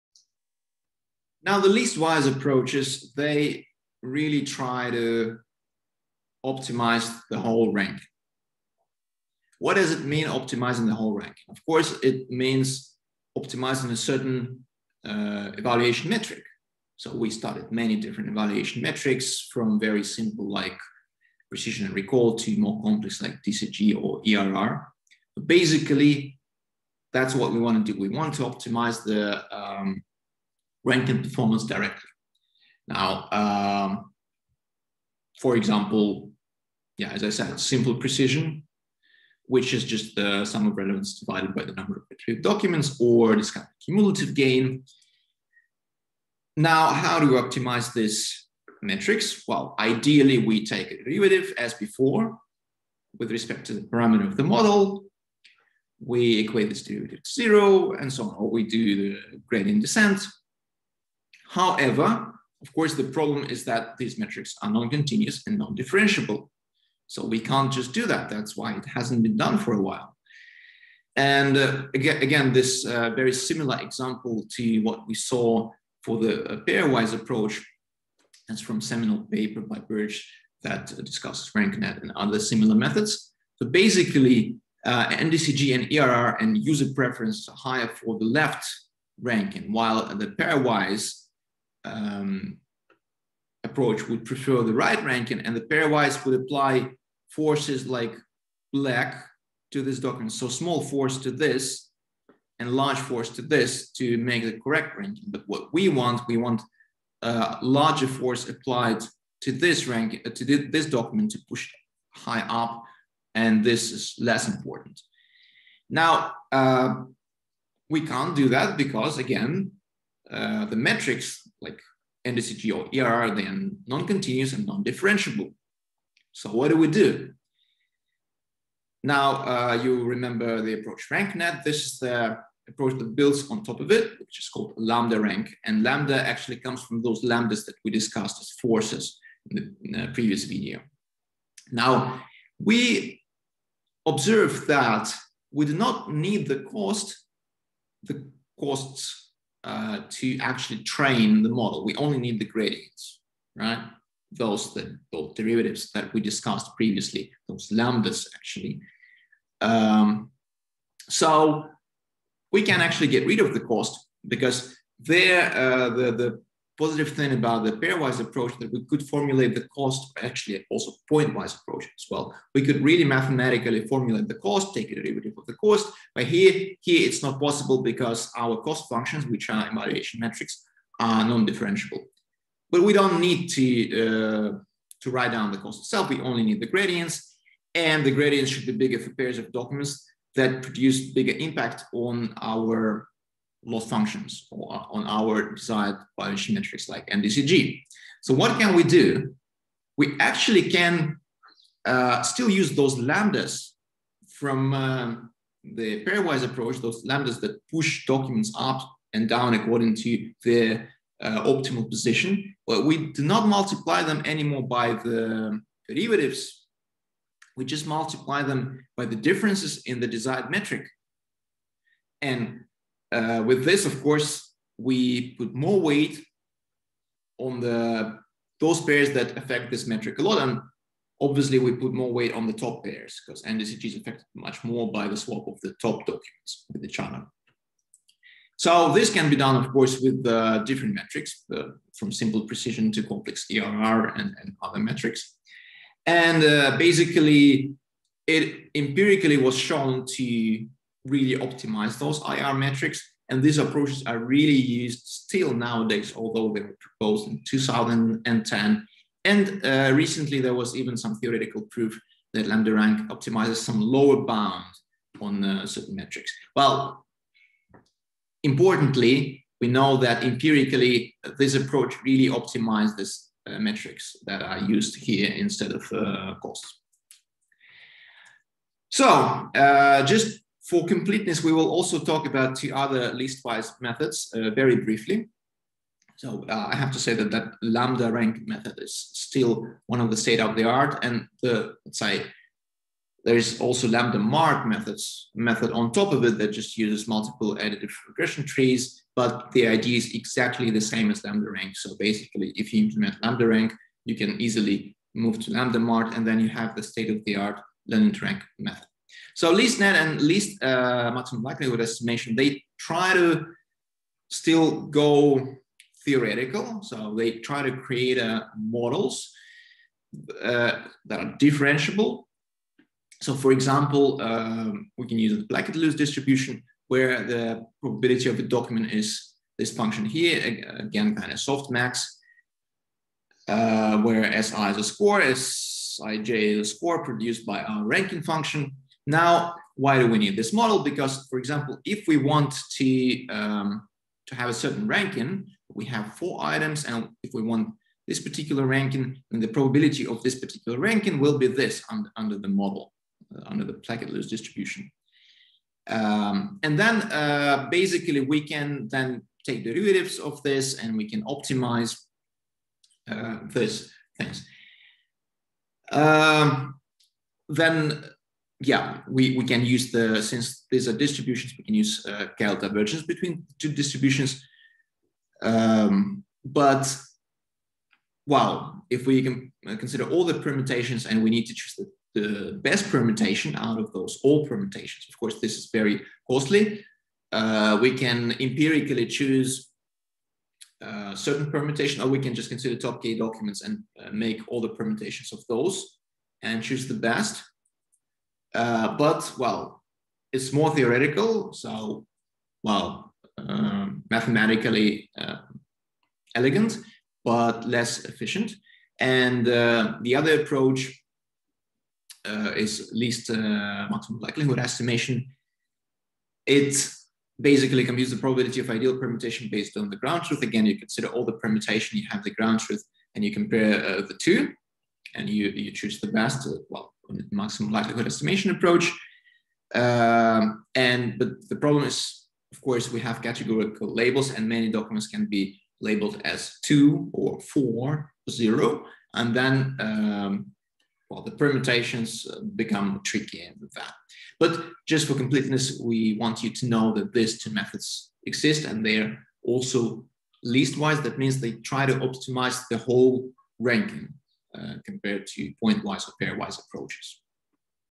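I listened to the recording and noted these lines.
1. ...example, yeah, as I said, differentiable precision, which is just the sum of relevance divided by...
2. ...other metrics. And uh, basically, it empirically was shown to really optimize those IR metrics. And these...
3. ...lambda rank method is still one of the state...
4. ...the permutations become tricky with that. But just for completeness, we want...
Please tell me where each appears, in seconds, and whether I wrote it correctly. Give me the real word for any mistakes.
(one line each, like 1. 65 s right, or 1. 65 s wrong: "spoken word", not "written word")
1. 35 s wrong: "simple", not "differentiable"
2. 244 s right
3. 287 s right
4. 441 s right.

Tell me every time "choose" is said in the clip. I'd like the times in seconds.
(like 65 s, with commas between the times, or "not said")
381 s, 389 s, 396 s, 425 s.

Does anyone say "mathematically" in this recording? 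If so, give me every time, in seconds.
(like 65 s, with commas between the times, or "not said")
173 s, 404 s.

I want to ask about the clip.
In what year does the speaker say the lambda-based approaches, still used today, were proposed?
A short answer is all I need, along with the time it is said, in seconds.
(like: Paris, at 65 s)
2010, at 257 s.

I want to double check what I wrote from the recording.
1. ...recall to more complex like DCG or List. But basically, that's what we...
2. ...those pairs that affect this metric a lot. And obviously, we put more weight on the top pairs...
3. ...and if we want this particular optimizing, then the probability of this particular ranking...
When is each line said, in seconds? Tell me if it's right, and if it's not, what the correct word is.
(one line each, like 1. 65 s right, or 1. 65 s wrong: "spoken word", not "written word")
1. 21 s wrong: "ERR", not "List"
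2. 228 s right
3. 346 s wrong: "ranking", not "optimizing".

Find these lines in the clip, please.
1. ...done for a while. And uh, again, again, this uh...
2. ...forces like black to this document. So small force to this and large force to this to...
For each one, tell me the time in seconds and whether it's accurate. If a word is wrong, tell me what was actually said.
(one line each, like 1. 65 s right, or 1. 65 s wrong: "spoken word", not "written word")
1. 69 s right
2. 97 s right.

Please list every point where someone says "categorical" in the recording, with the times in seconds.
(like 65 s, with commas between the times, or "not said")
433 s.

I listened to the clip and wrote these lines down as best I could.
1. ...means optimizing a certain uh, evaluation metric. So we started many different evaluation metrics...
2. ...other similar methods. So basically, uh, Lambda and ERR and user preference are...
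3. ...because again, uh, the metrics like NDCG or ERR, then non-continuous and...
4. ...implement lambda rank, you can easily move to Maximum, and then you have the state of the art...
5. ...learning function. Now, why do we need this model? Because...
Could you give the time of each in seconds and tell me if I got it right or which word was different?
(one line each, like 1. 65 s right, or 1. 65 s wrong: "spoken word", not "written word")
1. 12 s right
2. 82 s wrong: "NDCG", not "Lambda"
3. 118 s right
4. 302 s wrong: "LambdaMART", not "Maximum"
5. 337 s wrong: "ranking", not "learning".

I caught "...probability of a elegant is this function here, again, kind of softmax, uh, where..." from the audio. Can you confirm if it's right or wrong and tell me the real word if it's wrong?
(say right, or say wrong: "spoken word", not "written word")
wrong: "document", not "elegant".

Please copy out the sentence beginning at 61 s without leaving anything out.
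However, of course, the problem is that these metrics are non-continuous and non-differentiable.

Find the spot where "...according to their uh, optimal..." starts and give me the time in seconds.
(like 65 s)
209 s.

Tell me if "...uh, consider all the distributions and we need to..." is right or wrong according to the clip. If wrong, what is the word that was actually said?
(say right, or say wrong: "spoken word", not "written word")
wrong: "permutations", not "distributions".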